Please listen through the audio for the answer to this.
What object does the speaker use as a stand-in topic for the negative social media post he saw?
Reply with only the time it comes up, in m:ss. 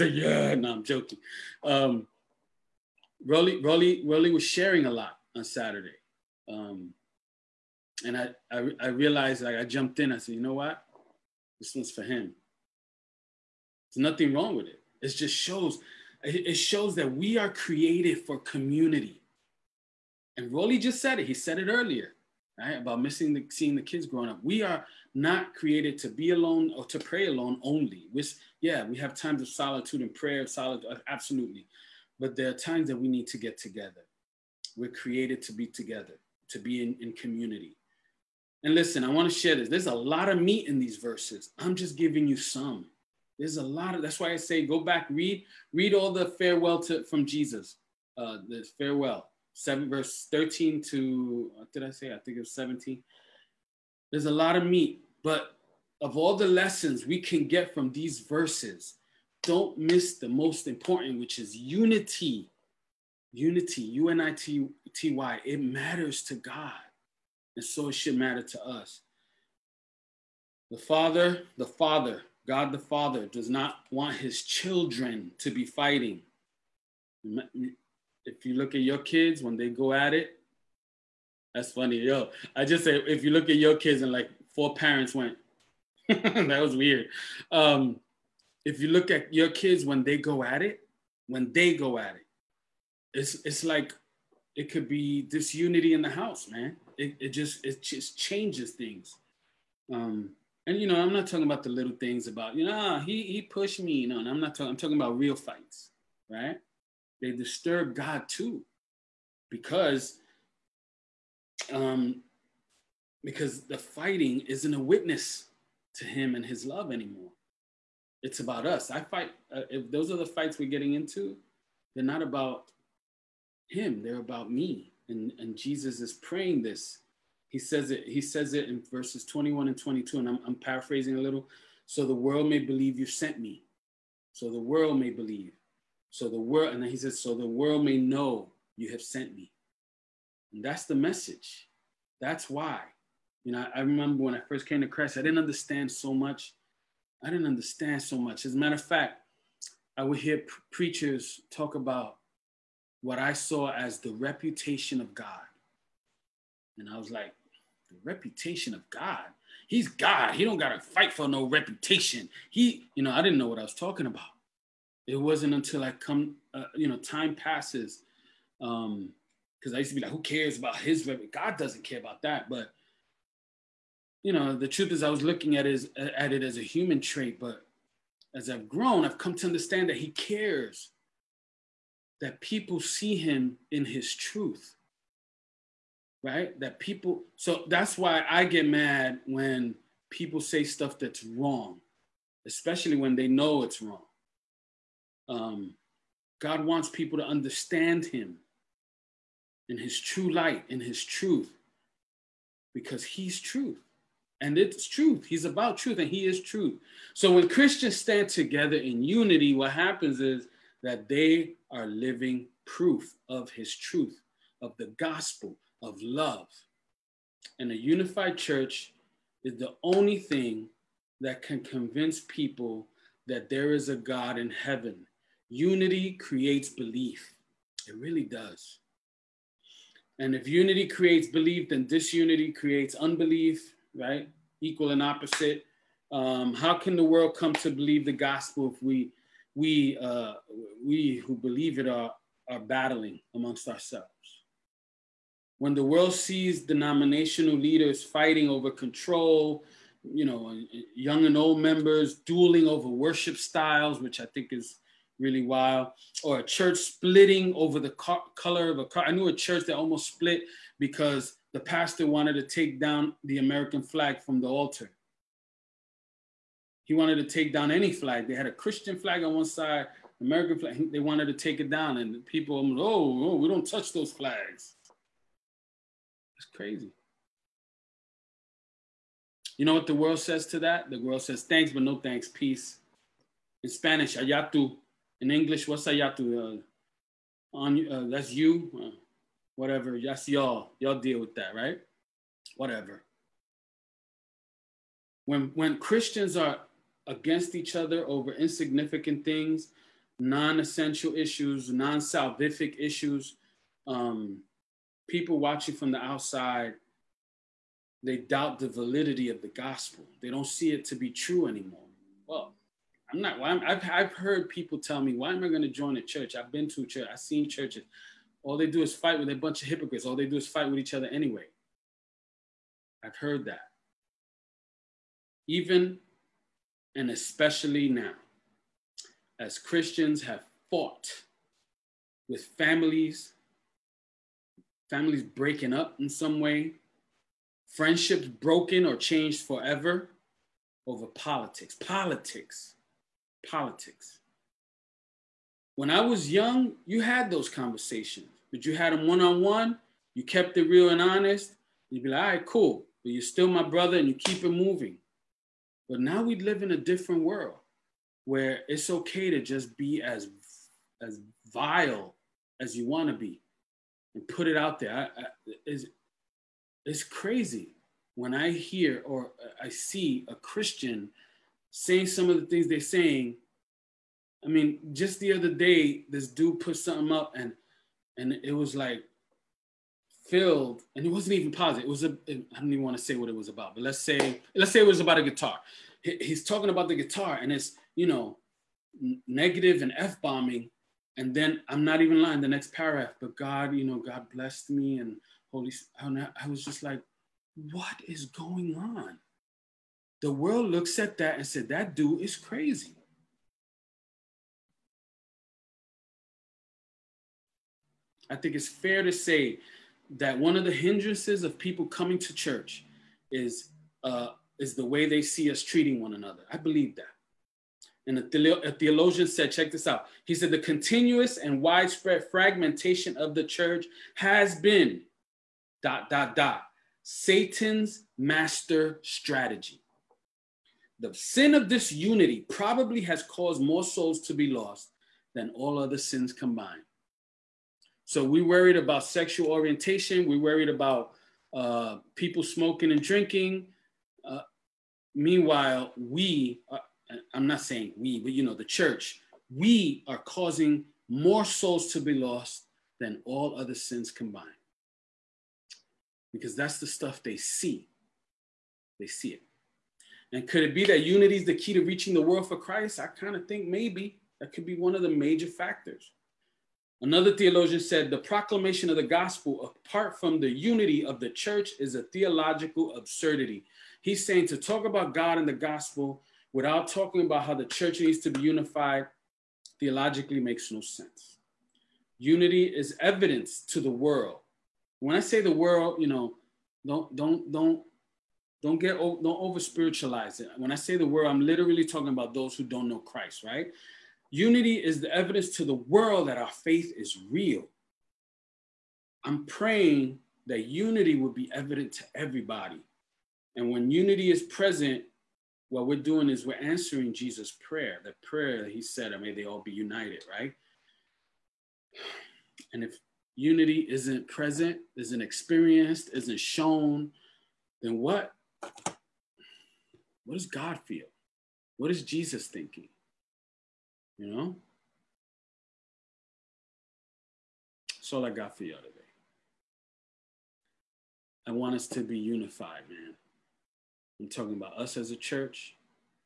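6:25.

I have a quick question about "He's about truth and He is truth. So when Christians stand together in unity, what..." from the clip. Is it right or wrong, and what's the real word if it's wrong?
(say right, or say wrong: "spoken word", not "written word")
right.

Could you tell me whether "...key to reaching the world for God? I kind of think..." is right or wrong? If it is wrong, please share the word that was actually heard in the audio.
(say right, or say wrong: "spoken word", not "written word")
wrong: "Christ", not "God".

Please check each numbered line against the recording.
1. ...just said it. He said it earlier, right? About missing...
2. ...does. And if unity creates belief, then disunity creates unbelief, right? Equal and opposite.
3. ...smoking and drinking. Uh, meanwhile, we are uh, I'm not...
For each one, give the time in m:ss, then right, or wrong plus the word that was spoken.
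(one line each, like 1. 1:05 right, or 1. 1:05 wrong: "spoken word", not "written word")
1. 0:20 right
2. 3:48 right
3. 7:22 right.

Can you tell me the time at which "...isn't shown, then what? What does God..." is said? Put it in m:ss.
8:36.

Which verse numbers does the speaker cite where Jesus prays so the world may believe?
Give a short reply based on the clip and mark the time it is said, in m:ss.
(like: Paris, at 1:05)
21 and 22, at 2:08.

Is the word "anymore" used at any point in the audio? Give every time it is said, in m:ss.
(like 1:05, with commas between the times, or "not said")
1:56, 5:11.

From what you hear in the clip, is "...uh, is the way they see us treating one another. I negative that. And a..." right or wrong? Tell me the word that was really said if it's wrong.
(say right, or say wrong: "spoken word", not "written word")
wrong: "believe", not "negative".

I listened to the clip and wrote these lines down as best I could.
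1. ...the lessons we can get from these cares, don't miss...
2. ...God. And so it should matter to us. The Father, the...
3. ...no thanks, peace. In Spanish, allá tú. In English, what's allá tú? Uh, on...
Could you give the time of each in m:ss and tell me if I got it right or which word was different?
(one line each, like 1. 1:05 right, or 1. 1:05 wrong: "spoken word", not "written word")
1. 0:56 wrong: "verses", not "cares"
2. 1:06 right
3. 4:41 right.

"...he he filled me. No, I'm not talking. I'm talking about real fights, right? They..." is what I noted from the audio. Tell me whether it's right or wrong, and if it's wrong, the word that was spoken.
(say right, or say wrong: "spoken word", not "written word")
wrong: "pushed", not "filled".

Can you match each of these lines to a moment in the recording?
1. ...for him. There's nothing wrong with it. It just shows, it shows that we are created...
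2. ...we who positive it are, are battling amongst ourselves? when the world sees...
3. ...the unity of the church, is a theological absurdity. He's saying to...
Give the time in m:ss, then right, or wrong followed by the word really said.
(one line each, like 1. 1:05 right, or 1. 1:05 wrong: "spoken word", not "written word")
1. 0:11 right
2. 4:00 wrong: "believe", not "positive"
3. 7:50 right.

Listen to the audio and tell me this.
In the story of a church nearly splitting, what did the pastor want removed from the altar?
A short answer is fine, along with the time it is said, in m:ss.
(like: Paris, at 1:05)
the American flag, at 4:23.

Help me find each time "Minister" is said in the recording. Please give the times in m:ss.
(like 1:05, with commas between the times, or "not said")
not said.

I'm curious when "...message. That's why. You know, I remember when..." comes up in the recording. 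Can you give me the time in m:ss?
2:20.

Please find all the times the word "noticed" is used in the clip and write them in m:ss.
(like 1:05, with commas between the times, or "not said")
not said.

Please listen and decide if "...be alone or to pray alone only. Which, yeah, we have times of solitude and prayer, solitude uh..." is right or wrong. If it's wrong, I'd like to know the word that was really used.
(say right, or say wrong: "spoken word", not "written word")
right.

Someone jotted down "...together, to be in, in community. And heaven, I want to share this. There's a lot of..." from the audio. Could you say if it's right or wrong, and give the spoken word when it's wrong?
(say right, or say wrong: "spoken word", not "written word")
wrong: "listen", not "heaven".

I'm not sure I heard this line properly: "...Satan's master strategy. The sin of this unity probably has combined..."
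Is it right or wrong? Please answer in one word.
wrong.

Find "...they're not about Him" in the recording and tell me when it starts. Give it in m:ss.
2:01.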